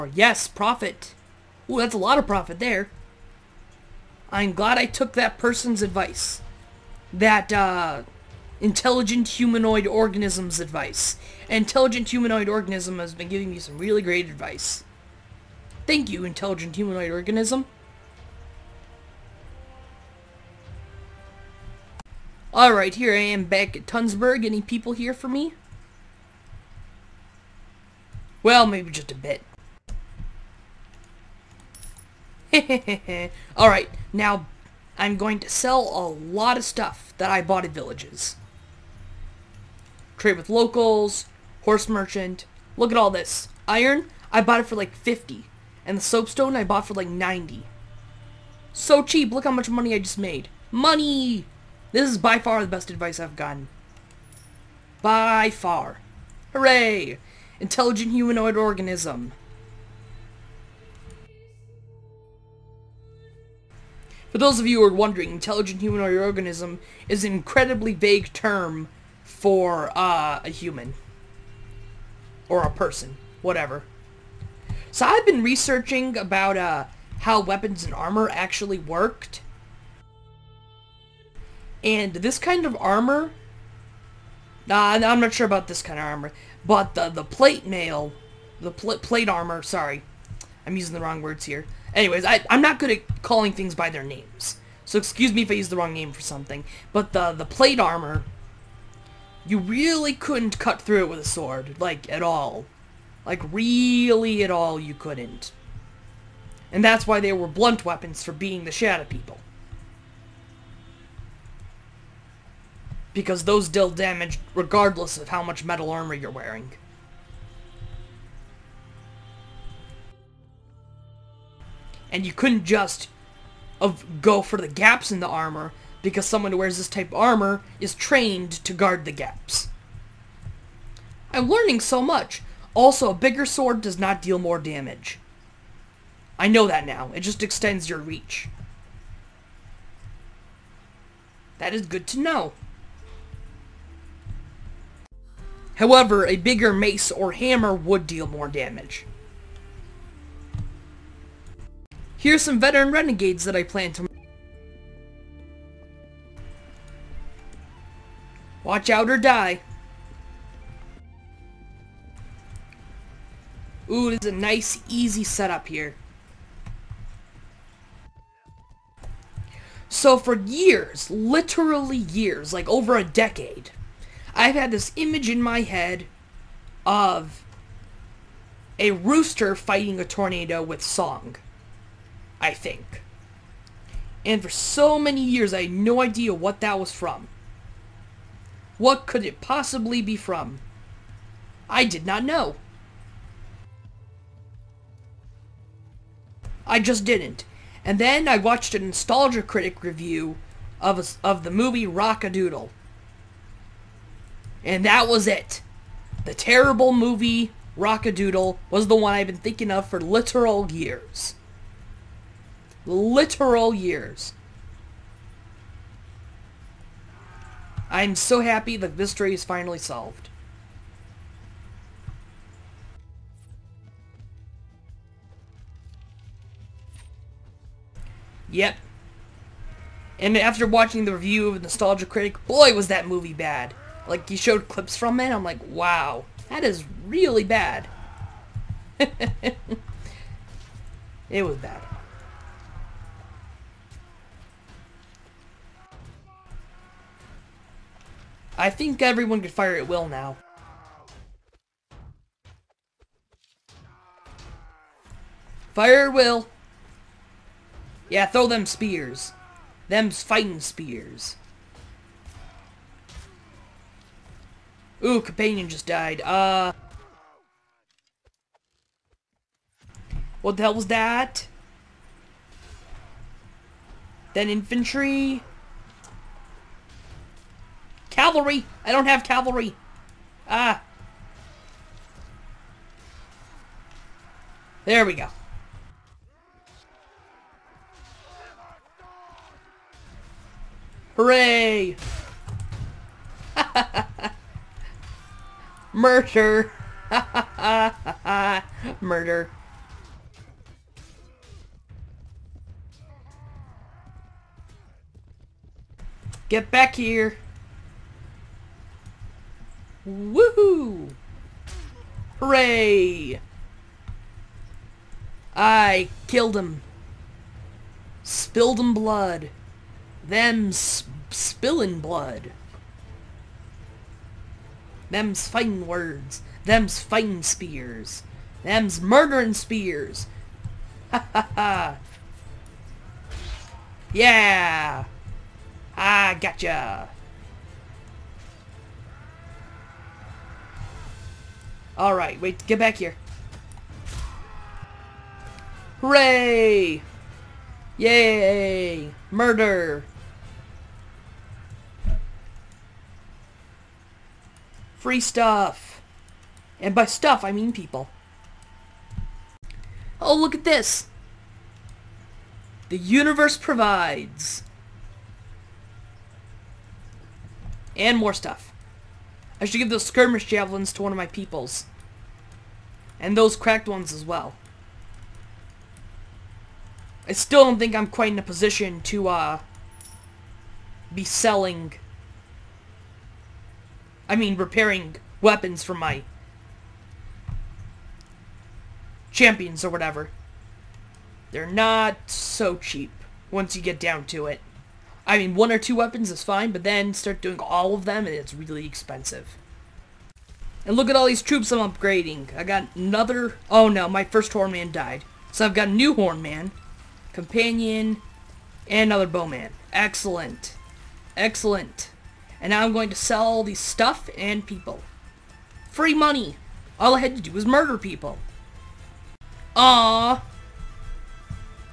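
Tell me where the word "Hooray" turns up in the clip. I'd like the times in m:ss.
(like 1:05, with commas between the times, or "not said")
0:56, 4:51, 5:12, 5:46.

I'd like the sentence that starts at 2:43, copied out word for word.
Ooh, this is a nice, easy setup here.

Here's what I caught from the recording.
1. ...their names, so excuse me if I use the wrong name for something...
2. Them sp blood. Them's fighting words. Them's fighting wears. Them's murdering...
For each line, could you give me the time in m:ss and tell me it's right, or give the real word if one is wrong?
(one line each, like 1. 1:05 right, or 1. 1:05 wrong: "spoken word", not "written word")
1. 1:33 right
2. 5:20 wrong: "spears", not "wears".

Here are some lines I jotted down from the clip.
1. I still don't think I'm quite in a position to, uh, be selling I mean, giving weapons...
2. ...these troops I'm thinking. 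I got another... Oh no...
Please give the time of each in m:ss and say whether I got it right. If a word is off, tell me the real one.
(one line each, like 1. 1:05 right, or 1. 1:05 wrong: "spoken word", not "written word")
1. 6:17 wrong: "repairing", not "giving"
2. 6:41 wrong: "upgrading", not "thinking".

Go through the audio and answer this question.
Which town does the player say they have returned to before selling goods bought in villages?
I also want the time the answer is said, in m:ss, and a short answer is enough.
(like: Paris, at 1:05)
Tunsberg, at 0:23.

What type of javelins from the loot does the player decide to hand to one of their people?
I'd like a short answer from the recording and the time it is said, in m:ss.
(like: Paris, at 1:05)
skirmish javelins, at 6:10.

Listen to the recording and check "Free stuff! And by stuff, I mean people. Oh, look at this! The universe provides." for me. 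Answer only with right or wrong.
right.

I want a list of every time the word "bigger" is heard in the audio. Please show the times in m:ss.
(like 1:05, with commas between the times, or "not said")
2:13, 2:26.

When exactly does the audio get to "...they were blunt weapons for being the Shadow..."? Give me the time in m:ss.
1:47.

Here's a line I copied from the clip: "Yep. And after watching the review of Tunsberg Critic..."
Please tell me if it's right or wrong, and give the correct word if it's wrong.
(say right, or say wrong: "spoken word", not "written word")
wrong: "Nostalgia", not "Tunsberg".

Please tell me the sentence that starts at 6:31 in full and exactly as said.
They're not so cheap once you get down to it.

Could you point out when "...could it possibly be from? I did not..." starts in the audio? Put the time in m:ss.
3:09.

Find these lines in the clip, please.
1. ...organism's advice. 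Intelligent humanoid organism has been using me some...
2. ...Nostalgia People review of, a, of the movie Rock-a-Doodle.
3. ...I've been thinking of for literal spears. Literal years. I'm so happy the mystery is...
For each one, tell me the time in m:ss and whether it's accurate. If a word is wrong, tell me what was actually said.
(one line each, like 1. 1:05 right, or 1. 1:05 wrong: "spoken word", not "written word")
1. 0:09 wrong: "giving", not "using"
2. 3:18 wrong: "Critic", not "People"
3. 3:29 wrong: "years", not "spears".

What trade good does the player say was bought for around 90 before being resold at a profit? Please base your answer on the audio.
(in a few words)
soapstone.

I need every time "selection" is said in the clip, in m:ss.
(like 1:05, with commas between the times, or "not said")
not said.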